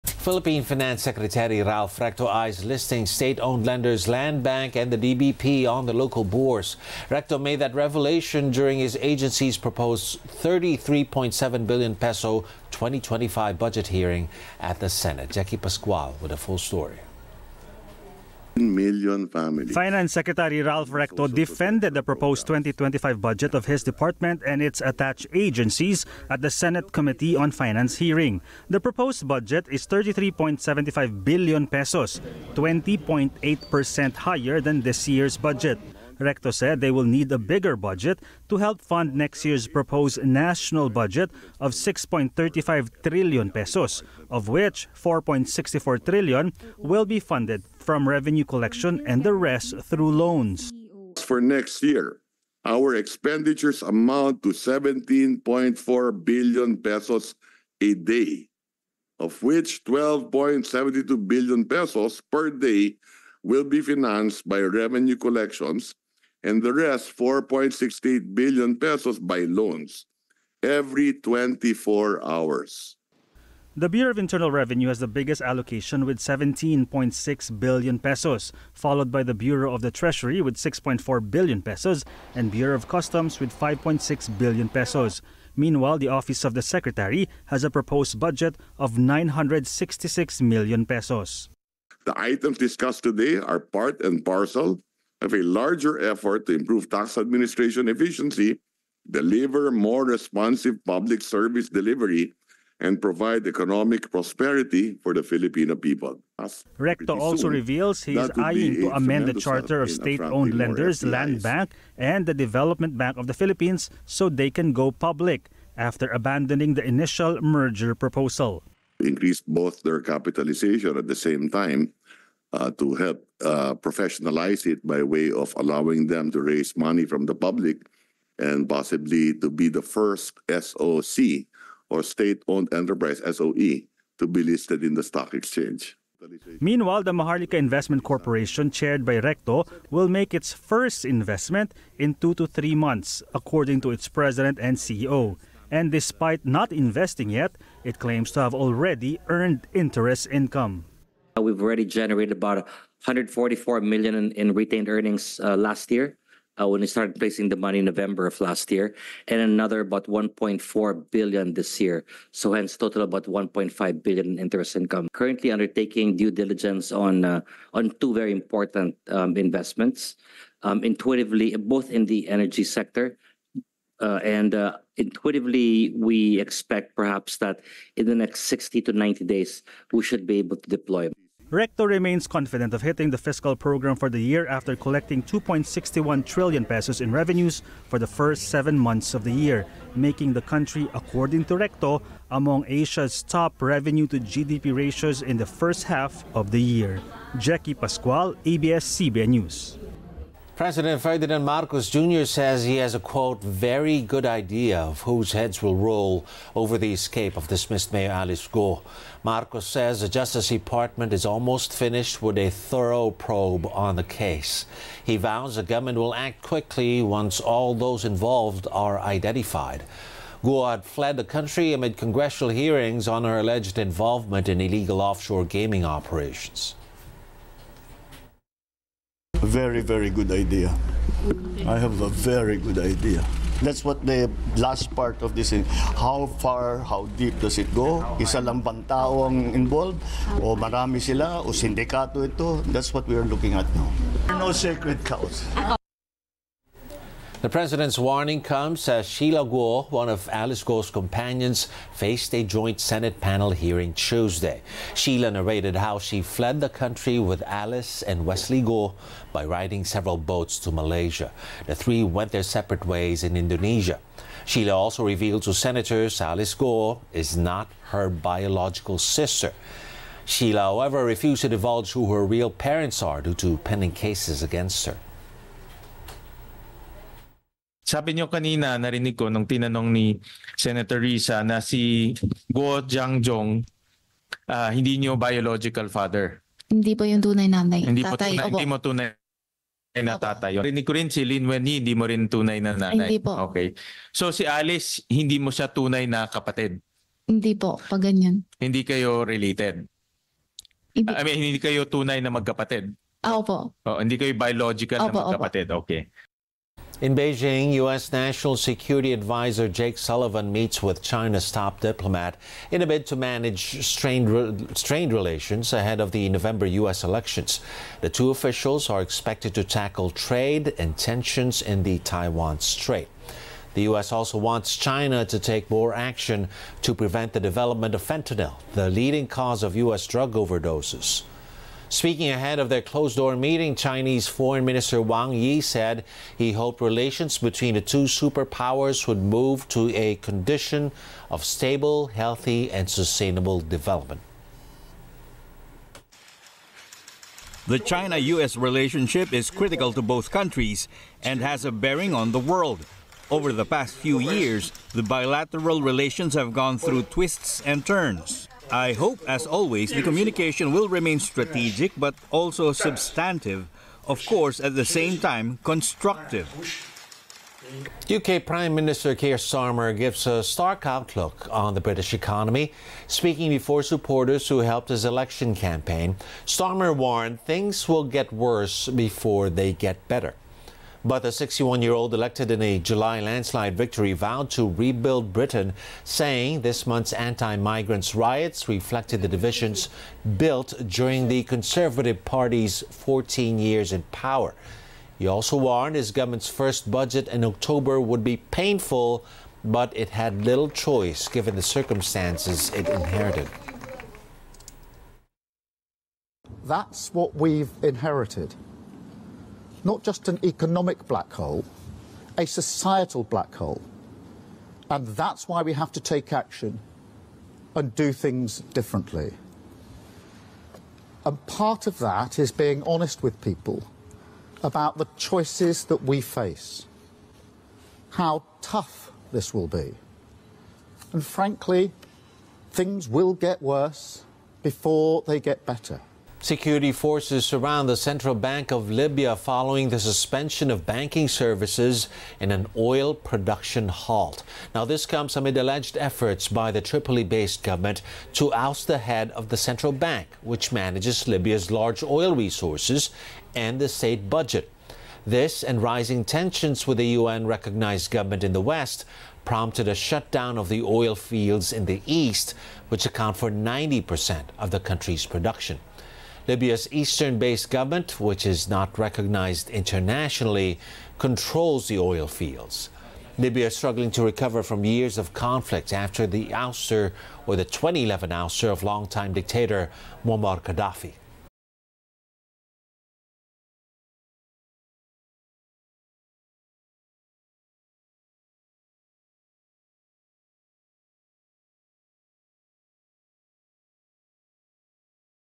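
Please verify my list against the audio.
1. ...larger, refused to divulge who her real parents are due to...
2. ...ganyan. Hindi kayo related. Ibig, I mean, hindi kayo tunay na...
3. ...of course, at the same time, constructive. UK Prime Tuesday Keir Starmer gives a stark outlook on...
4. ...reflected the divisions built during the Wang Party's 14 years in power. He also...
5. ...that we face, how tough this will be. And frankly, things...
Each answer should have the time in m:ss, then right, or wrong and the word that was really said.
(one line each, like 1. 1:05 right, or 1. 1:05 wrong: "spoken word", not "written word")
1. 4:30 wrong: "however", not "larger"
2. 4:58 right
3. 6:04 wrong: "Minister", not "Tuesday"
4. 6:28 wrong: "Conservative", not "Wang"
5. 7:05 right.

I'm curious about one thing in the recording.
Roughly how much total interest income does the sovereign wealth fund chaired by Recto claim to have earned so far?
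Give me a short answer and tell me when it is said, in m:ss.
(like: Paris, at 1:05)
1.5 billion, at 2:43.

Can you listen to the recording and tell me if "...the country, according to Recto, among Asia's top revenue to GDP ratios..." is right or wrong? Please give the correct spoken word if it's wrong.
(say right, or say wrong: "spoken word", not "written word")
right.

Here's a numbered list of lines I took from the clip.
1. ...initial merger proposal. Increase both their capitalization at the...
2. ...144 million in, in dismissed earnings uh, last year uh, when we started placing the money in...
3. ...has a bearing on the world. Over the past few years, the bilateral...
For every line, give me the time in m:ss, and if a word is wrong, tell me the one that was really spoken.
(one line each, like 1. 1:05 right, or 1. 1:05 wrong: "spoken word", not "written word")
1. 1:56 right
2. 2:33 wrong: "retained", not "dismissed"
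3. 5:51 right.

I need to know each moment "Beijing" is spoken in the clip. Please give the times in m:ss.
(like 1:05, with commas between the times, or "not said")
5:07.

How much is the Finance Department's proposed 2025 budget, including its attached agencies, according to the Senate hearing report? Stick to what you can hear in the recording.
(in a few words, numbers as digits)
33.75 billion pesos.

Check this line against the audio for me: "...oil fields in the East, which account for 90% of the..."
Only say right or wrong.
right.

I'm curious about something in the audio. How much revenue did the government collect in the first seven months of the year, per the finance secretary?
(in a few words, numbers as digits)
2.61 trillion pesos.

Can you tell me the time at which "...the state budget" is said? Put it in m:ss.
7:33.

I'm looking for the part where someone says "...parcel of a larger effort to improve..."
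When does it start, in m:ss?
1:34.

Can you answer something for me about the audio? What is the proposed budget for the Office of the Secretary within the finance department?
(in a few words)
966 million pesos.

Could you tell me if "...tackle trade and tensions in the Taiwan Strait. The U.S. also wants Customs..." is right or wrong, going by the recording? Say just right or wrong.
wrong.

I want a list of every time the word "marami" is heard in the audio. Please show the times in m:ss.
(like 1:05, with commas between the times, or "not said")
4:00.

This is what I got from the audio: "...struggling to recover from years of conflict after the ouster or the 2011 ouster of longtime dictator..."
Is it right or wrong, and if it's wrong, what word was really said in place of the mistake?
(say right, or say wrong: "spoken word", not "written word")
right.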